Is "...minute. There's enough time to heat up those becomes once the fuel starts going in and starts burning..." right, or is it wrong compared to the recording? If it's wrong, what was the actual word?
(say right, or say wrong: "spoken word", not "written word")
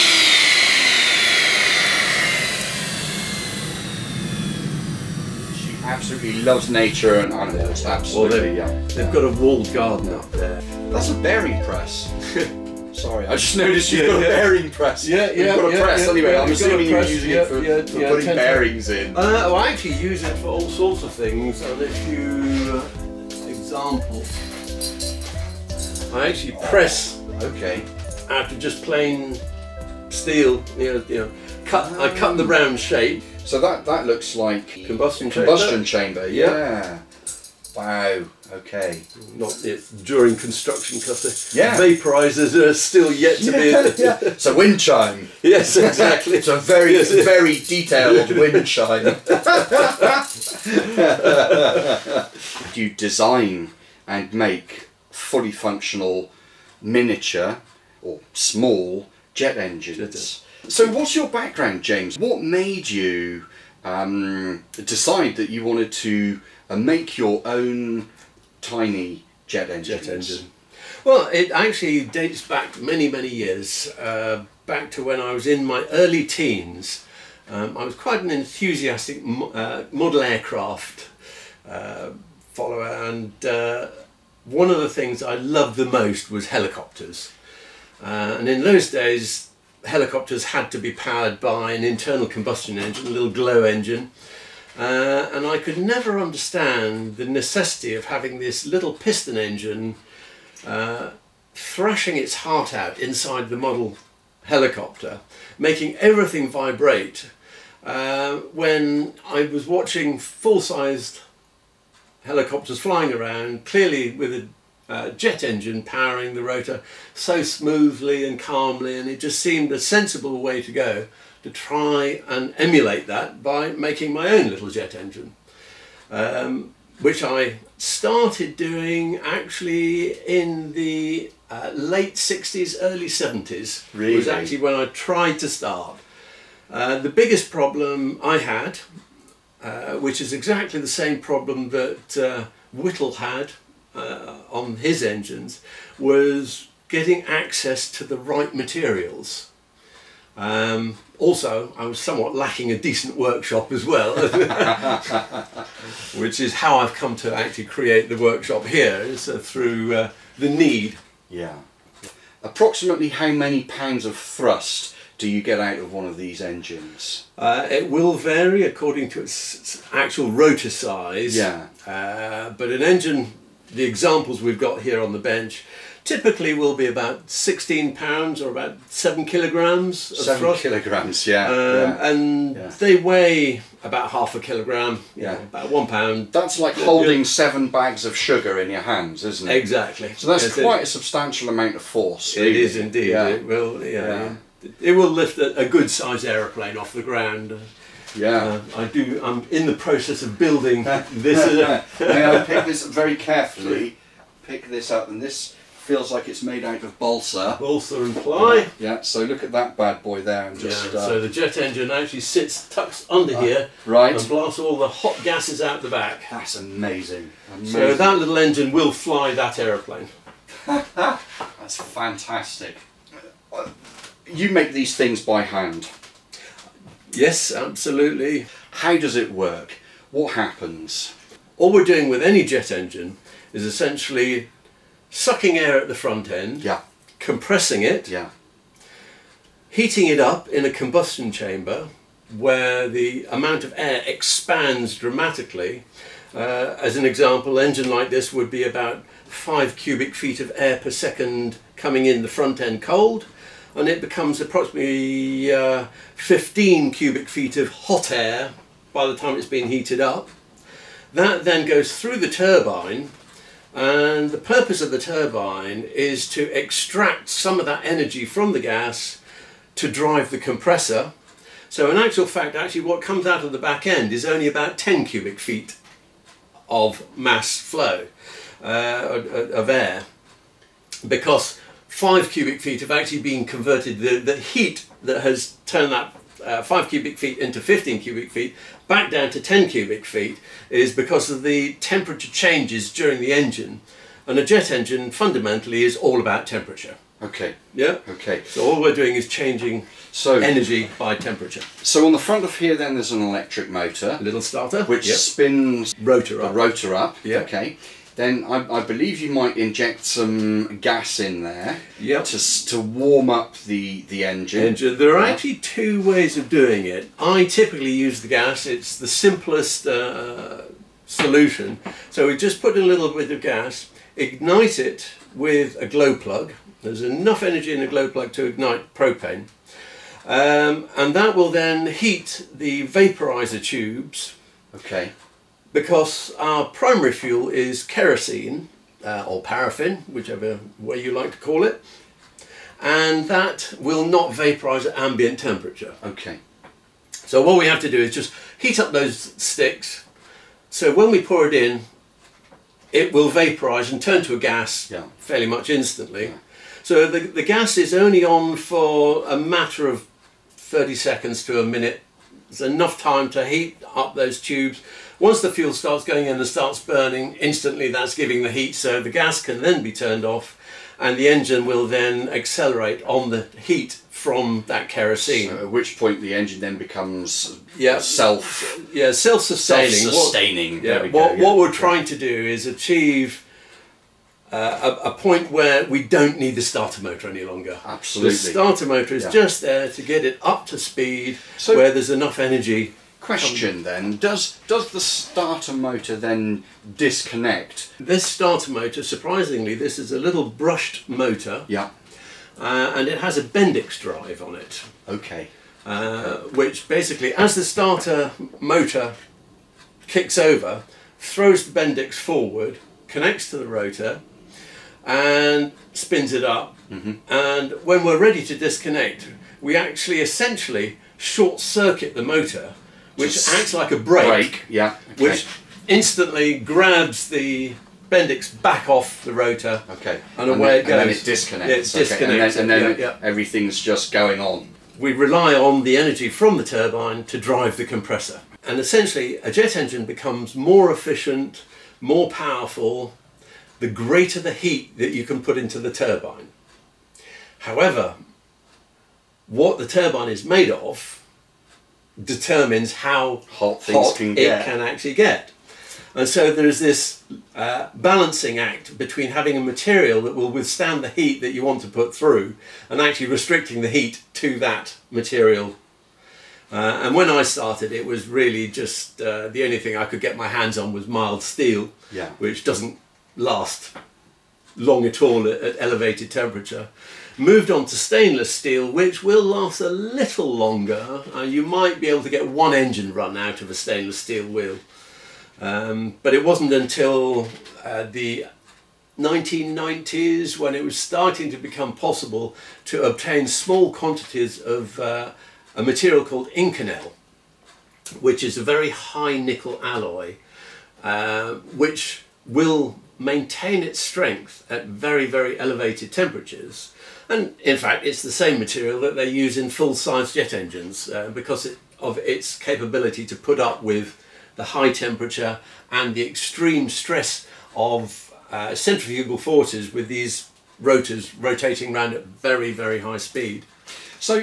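wrong: "tubes", not "becomes".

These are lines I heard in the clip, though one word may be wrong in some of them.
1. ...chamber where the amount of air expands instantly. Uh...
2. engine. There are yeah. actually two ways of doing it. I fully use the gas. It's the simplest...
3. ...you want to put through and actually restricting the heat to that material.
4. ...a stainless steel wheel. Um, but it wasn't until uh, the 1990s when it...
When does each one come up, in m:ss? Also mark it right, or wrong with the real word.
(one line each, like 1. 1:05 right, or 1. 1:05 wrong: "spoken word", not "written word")
1. 4:01 wrong: "dramatically", not "instantly"
2. 5:14 wrong: "typically", not "fully"
3. 7:41 right
4. 8:03 right.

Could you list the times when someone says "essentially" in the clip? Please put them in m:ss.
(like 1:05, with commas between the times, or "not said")
3:53, 7:00, 7:18.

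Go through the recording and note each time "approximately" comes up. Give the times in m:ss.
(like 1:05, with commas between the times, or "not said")
2:42, 4:14.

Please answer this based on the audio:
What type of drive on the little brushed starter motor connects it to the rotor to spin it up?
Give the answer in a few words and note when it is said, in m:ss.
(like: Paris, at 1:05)
Bendix drive, at 6:43.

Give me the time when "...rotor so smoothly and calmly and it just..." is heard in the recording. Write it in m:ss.
1:56.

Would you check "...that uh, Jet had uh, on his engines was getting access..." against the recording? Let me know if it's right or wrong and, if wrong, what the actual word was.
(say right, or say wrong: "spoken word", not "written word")
wrong: "Whittle", not "Jet".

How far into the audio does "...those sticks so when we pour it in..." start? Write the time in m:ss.
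5:48.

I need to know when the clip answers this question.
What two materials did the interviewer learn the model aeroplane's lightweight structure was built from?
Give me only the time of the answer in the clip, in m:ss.
3:27.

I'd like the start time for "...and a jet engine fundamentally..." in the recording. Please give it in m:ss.
4:54.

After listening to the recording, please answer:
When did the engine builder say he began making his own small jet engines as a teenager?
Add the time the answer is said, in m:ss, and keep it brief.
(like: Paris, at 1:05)
late 60s early 70s, at 2:11.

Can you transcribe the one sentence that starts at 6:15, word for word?
So at which point the engine then becomes yeah.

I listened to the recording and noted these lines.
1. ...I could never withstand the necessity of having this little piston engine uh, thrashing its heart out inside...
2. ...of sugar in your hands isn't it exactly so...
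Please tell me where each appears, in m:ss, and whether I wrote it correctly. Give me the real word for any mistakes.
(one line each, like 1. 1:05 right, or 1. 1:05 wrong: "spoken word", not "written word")
1. 1:35 wrong: "understand", not "withstand"
2. 3:08 right.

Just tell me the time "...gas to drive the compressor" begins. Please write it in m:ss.
4:28.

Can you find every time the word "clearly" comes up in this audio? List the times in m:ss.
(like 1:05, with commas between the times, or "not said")
1:53.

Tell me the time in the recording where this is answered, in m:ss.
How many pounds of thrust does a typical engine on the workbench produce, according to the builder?
2:57.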